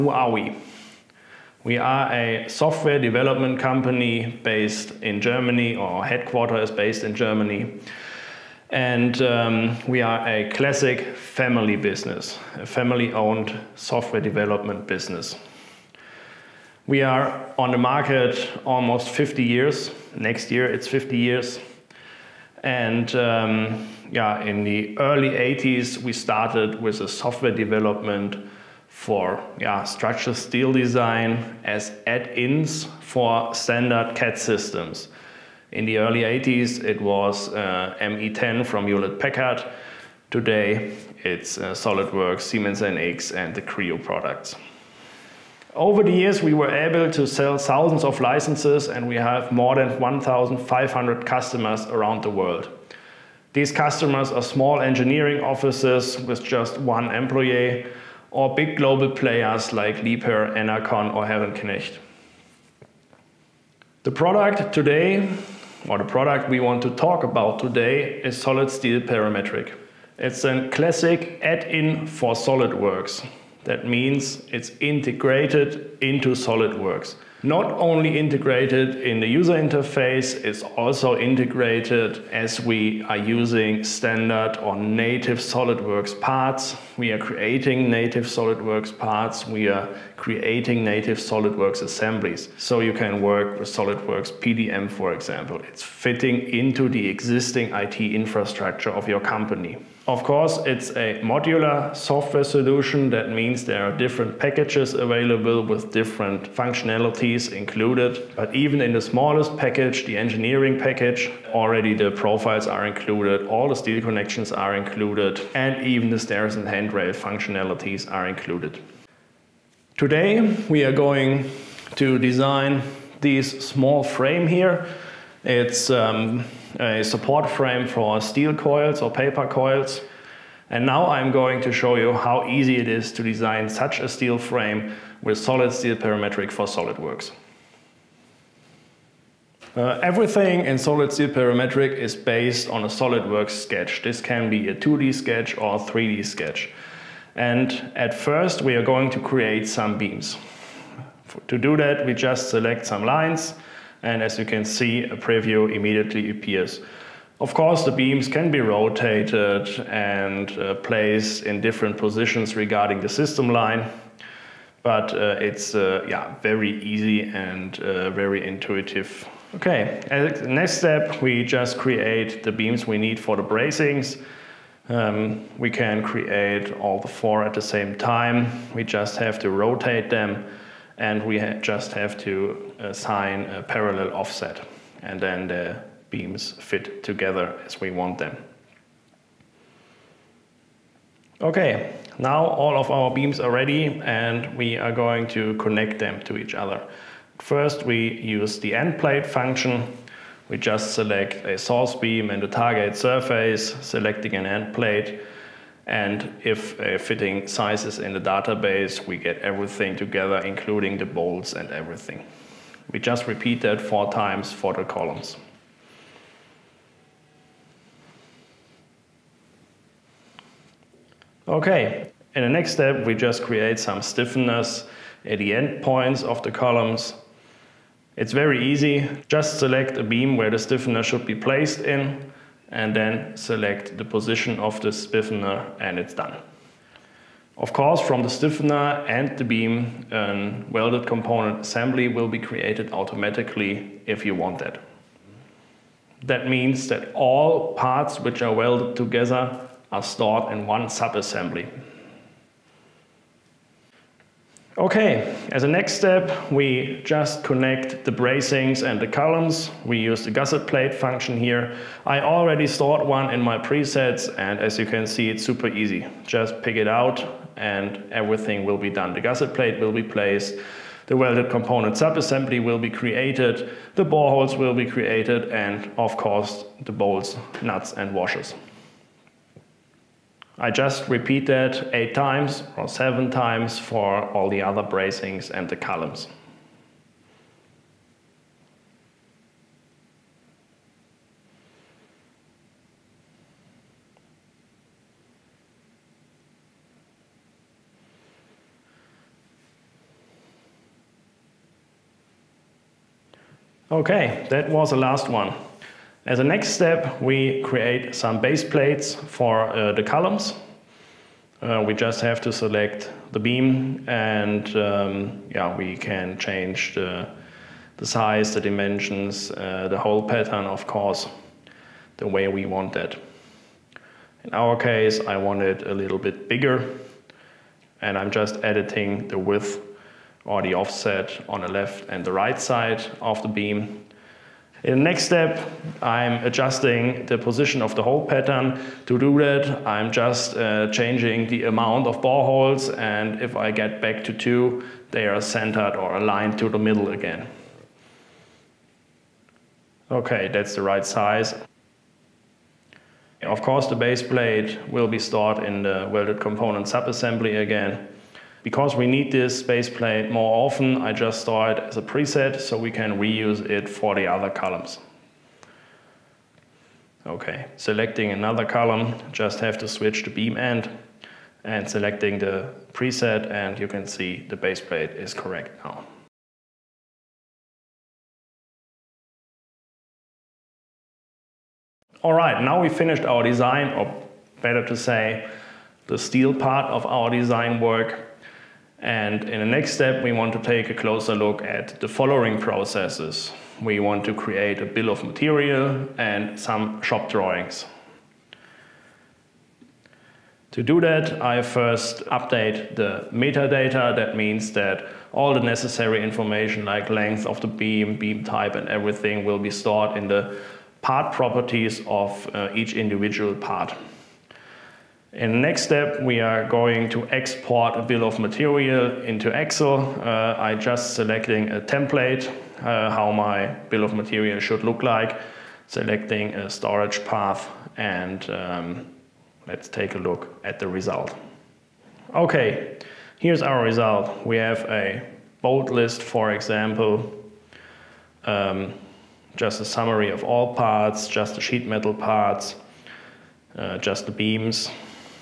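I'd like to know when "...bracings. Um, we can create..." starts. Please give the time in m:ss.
2:53.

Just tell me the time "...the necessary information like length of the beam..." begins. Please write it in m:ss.
6:45.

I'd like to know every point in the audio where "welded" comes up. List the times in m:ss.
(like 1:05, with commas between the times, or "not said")
4:00, 4:08, 4:31, 5:56.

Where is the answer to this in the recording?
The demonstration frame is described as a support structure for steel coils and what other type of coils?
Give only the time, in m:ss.
2:09.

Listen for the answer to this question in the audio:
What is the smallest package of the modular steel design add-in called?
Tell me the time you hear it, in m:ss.
1:50.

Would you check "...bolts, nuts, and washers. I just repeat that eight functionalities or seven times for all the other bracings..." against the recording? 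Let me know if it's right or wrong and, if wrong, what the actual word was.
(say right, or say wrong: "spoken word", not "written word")
wrong: "times", not "functionalities".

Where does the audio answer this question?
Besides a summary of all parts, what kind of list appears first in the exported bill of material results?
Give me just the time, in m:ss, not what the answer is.
7:15.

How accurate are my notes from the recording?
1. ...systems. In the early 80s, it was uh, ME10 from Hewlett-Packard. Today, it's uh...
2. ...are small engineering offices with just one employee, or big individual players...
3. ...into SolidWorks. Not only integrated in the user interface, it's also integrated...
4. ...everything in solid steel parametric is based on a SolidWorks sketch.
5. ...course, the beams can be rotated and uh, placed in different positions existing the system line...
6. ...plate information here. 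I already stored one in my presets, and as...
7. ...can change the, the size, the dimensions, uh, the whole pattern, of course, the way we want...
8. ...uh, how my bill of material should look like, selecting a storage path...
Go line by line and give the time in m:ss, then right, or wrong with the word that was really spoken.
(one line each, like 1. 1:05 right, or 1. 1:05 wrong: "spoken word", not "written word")
1. 0:34 right
2. 0:54 wrong: "global", not "individual"
3. 1:15 right
4. 2:20 right
5. 2:37 wrong: "regarding", not "existing"
6. 4:20 wrong: "function", not "information"
7. 5:15 right
8. 7:02 right.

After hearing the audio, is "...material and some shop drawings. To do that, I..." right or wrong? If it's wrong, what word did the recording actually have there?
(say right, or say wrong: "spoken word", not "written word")
right.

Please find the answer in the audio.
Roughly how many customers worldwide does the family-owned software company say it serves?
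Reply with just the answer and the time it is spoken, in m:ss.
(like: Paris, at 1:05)
more than 1,500, at 0:49.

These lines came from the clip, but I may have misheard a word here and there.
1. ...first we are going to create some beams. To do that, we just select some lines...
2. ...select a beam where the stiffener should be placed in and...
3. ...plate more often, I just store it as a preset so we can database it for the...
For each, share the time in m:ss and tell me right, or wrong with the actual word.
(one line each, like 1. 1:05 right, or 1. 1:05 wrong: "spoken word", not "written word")
1. 2:28 right
2. 3:49 right
3. 5:59 wrong: "reuse", not "database".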